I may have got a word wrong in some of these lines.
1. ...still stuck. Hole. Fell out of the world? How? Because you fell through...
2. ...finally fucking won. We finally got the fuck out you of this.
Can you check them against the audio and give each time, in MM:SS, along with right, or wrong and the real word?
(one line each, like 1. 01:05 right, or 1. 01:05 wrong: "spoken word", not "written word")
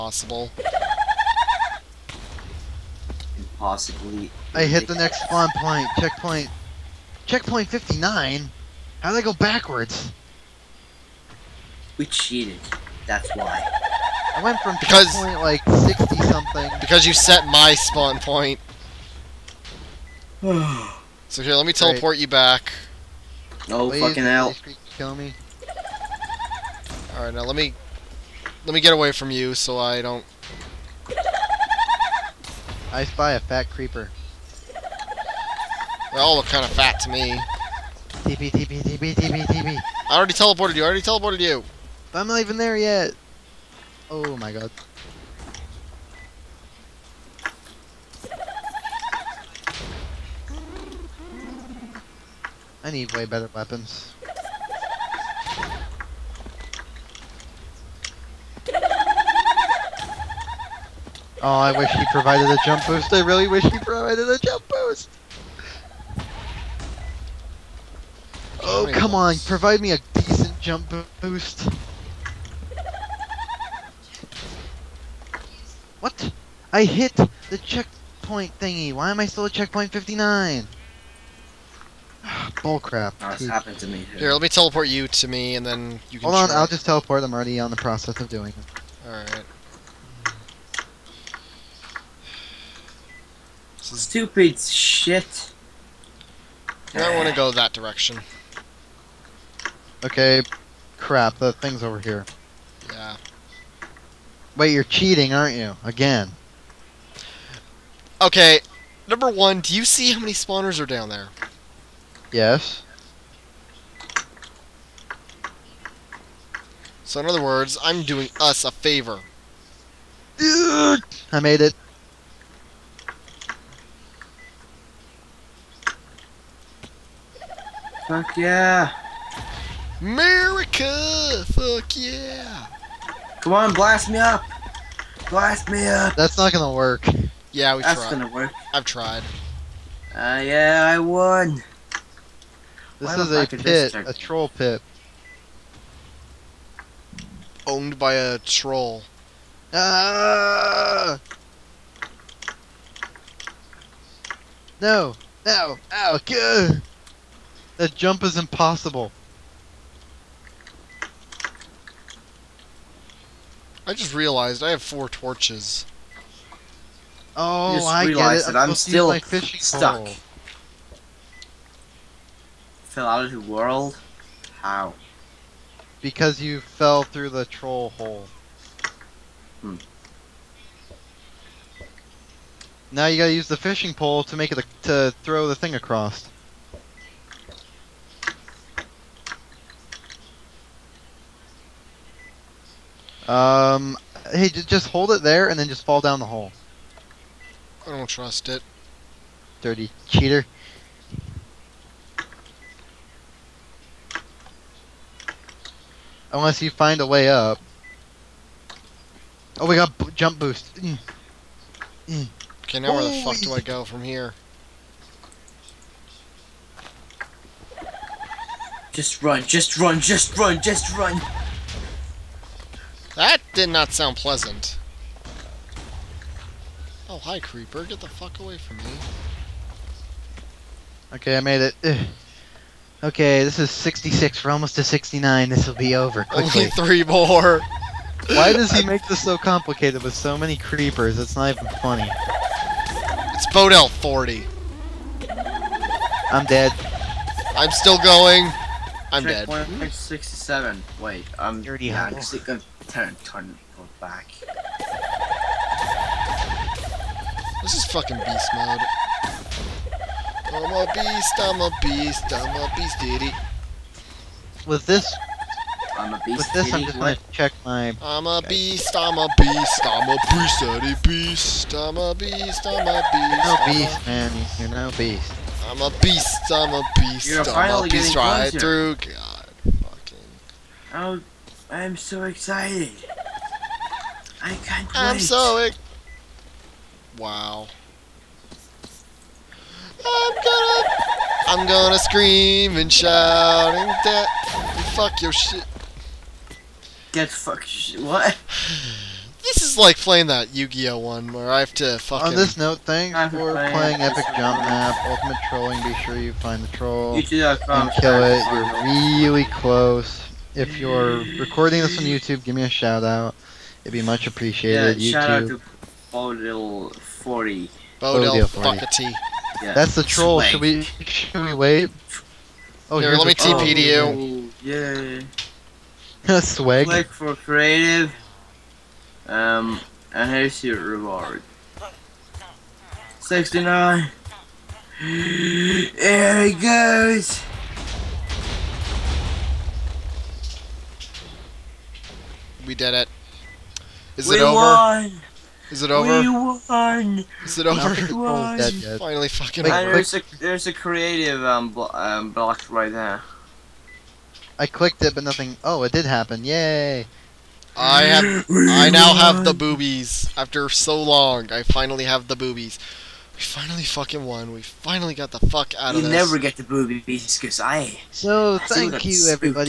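1. 02:48 right
2. 06:03 right.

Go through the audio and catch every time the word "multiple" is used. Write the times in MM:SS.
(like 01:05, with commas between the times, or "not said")
not said.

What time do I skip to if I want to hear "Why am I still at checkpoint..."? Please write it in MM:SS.
01:18.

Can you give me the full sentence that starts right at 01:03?
I really wish he provided a jump boost.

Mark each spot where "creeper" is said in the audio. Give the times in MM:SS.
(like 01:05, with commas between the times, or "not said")
00:33, 03:47, 04:00.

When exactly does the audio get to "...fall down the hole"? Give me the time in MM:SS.
03:15.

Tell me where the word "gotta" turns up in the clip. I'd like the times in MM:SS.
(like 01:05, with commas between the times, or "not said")
03:03.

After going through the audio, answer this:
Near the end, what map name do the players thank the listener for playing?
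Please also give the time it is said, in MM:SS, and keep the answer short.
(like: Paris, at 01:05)
Epic Jump Map, Ultimate Trolling, at 05:04.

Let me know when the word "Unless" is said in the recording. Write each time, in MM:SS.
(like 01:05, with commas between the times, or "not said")
03:26.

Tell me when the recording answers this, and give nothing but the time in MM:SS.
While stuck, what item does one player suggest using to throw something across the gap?
03:03.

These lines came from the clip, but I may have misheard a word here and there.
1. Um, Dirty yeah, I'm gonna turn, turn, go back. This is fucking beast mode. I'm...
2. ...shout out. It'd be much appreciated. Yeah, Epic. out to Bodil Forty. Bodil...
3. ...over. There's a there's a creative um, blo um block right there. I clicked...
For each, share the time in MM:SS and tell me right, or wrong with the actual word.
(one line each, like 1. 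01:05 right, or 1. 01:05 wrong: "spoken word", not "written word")
1. 04:11 right
2. 05:12 wrong: "YouTube", not "Epic"
3. 05:49 right.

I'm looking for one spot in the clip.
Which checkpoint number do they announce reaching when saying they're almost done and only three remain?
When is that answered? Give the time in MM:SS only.
03:53.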